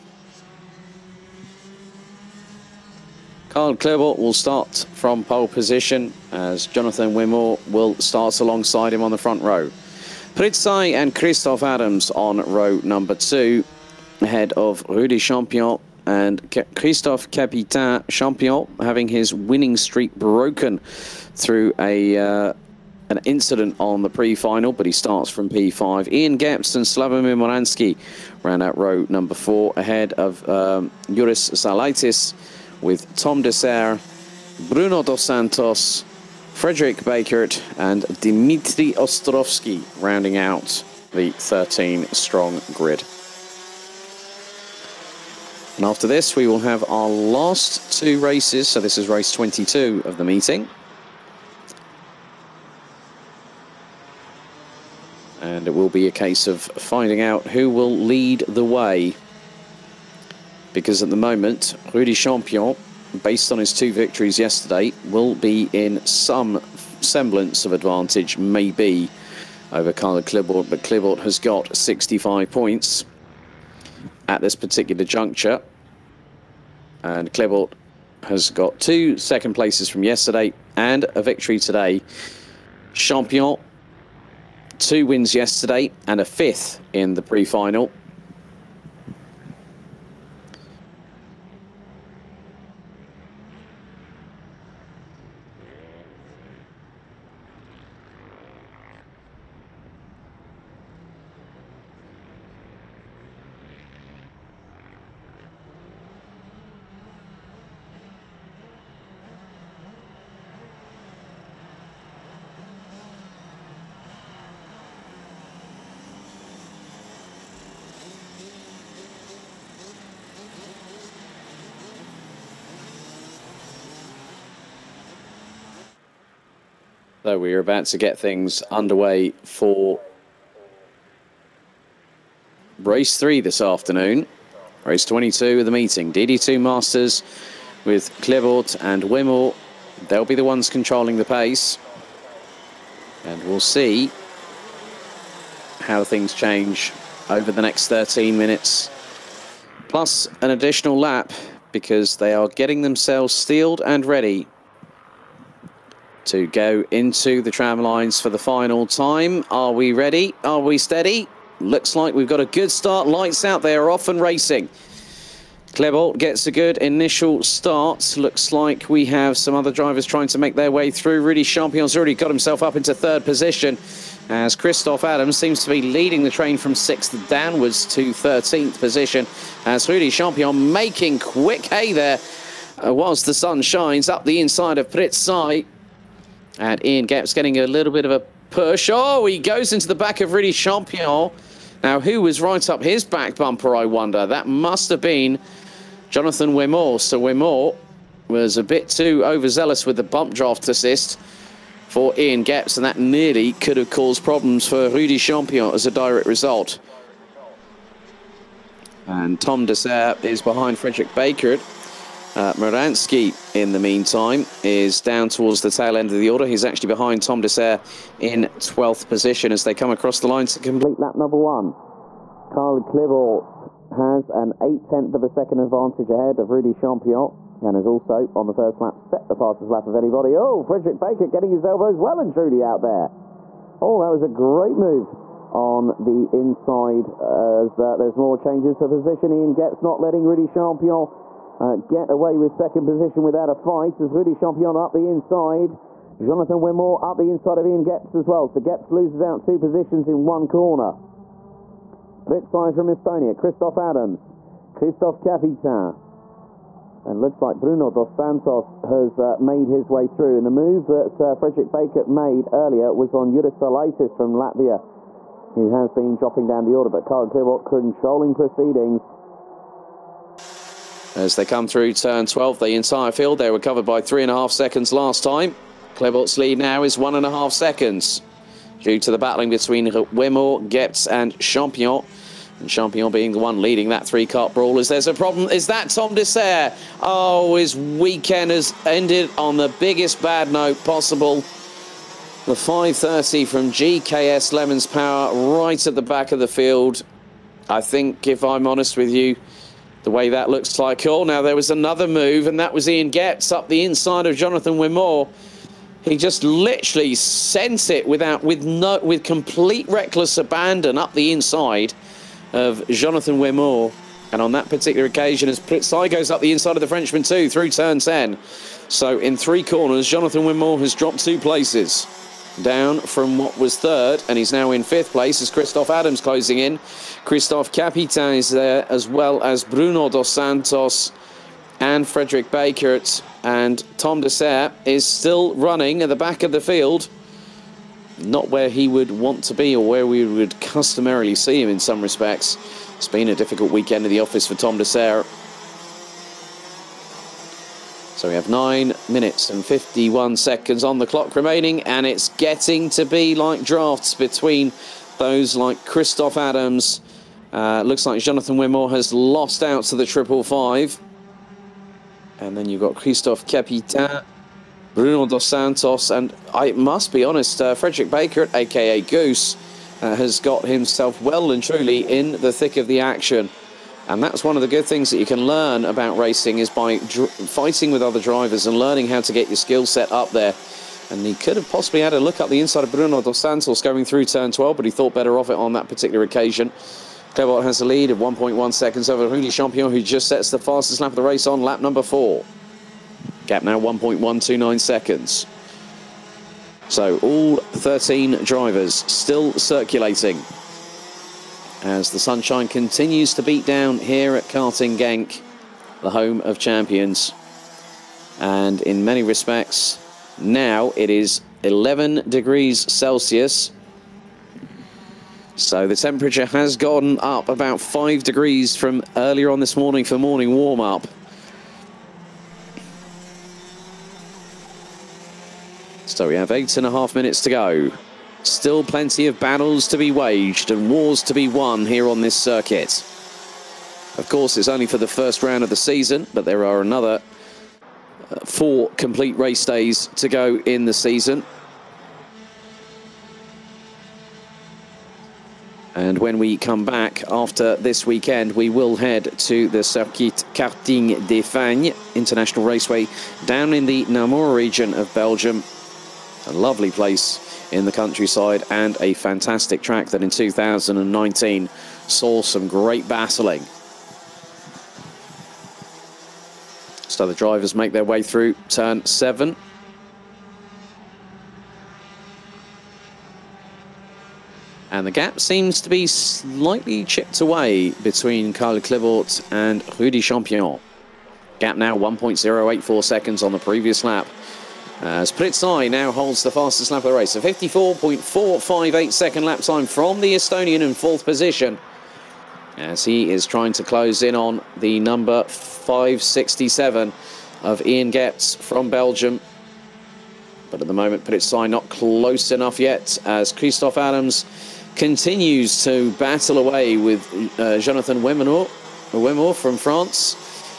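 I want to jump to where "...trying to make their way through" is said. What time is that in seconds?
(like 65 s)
170 s.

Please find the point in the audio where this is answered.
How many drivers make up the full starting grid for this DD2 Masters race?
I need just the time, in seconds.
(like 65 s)
41 s.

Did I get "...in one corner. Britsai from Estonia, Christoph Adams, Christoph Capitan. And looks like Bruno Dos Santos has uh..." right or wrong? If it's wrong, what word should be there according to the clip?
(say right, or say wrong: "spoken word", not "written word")
right.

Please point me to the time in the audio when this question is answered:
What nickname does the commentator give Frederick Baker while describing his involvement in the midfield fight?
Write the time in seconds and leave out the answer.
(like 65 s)
369 s.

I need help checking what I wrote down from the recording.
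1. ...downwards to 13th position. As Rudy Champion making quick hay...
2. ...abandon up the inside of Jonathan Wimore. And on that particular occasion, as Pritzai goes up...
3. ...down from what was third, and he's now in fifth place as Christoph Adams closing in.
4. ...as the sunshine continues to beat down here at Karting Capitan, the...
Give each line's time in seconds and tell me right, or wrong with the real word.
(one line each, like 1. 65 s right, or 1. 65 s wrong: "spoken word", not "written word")
1. 177 s right
2. 310 s right
3. 322 s right
4. 401 s wrong: "Genk", not "Capitan".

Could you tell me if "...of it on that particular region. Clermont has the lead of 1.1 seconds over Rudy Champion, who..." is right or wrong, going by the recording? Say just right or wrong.
wrong.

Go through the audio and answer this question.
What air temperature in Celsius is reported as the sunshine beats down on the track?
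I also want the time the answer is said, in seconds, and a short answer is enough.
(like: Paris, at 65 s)
11 degrees, at 411 s.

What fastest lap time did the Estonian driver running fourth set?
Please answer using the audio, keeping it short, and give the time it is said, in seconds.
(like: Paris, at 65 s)
54.458 seconds, at 487 s.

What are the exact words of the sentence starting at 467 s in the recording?
So the drivers make their way through turn seven.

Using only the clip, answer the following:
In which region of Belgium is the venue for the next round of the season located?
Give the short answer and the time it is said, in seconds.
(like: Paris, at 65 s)
Namur, at 454 s.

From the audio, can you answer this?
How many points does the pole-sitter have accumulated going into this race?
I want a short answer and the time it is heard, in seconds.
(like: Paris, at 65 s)
65, at 71 s.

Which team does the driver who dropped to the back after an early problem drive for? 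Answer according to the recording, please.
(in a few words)
GKS Lemons Power.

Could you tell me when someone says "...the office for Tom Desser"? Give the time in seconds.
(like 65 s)
344 s.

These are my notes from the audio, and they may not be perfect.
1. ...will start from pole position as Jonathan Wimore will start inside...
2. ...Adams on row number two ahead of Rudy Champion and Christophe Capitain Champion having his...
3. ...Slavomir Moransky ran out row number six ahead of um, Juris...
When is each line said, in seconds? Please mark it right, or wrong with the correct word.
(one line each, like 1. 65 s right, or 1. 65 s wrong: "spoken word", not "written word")
1. 4 s wrong: "alongside", not "inside"
2. 11 s right
3. 26 s wrong: "four", not "six".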